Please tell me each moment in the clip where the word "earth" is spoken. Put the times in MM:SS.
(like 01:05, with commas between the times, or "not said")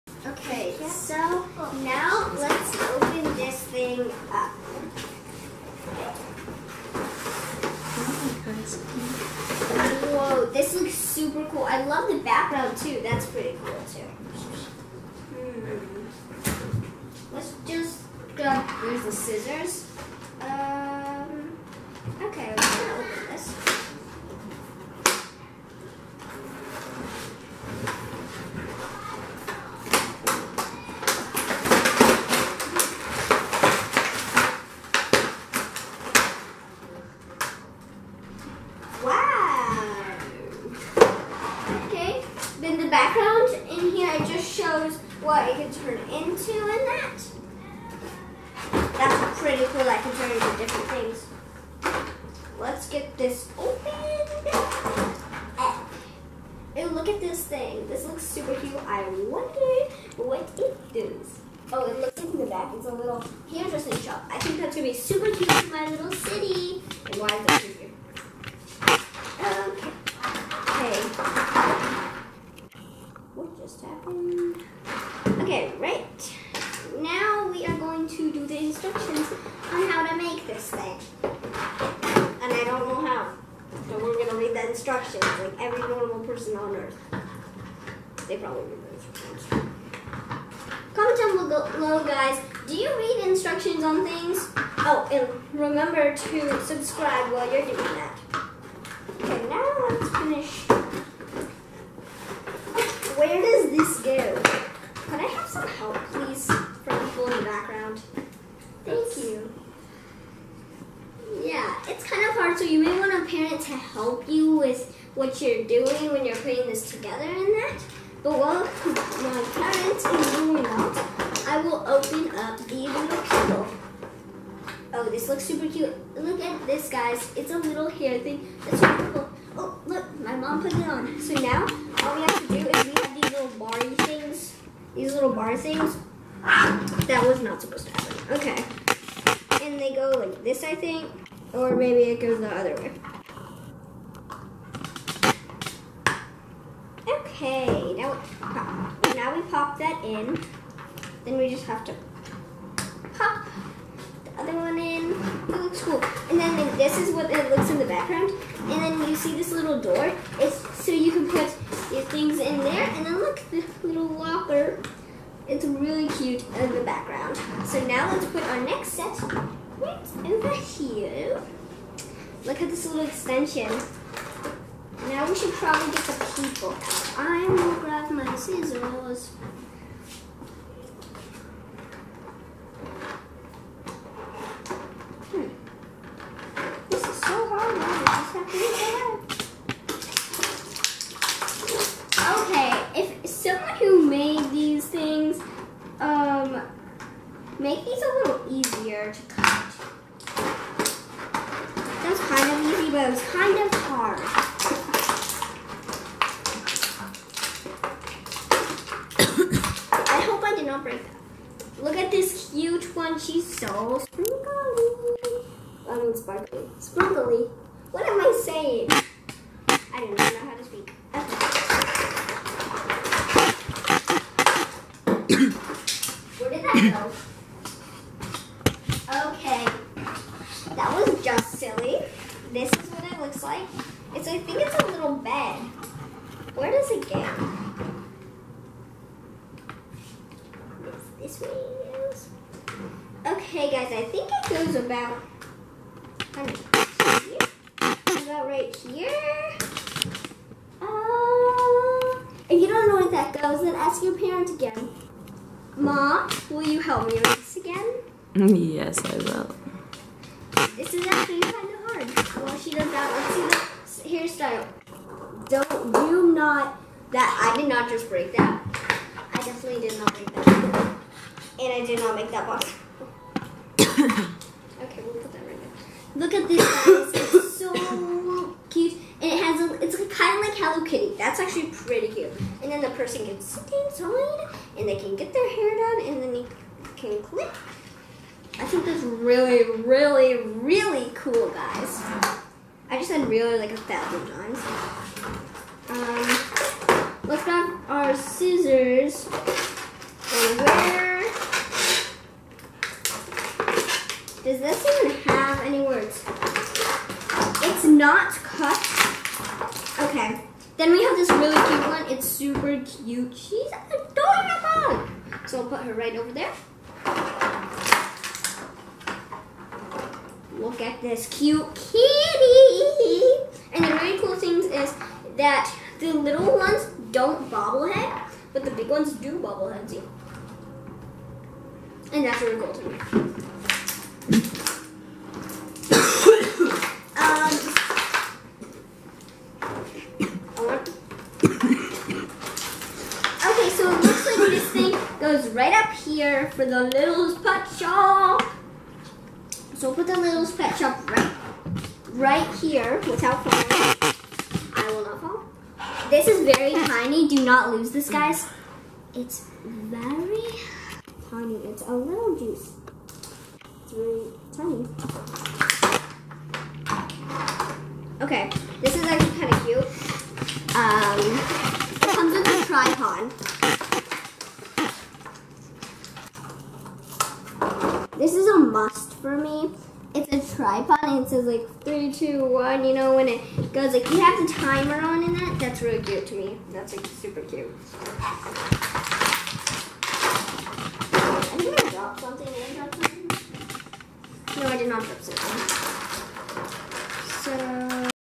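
01:26.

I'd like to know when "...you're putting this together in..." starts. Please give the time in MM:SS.
01:56.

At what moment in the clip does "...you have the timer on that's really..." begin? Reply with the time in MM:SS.
06:24.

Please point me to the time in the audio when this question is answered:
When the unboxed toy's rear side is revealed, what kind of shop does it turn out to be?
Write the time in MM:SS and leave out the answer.
01:03.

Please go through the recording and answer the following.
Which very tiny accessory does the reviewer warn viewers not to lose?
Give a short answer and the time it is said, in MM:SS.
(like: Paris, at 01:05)
juice, at 06:01.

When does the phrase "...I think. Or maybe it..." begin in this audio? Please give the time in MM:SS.
02:20.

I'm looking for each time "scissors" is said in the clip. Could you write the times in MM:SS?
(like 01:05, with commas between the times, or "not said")
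00:19, 02:58, 04:58.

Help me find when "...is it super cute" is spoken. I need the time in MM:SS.
01:07.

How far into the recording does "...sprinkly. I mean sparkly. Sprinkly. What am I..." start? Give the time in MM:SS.
03:34.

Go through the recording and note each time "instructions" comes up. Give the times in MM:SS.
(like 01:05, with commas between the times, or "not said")
01:18, 01:24, 01:28, 01:33.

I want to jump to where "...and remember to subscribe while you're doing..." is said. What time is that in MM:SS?
01:35.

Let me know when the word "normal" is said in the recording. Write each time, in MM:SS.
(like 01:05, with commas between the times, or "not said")
01:25.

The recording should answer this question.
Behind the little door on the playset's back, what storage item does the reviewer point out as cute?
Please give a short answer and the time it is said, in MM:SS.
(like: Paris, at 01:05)
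locker, at 02:43.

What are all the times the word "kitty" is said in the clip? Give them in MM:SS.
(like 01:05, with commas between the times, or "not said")
04:40, 05:21.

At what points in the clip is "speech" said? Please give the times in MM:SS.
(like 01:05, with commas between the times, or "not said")
not said.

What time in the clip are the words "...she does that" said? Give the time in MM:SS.
04:22.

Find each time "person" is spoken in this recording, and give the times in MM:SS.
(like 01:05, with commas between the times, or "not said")
01:26, 04:42.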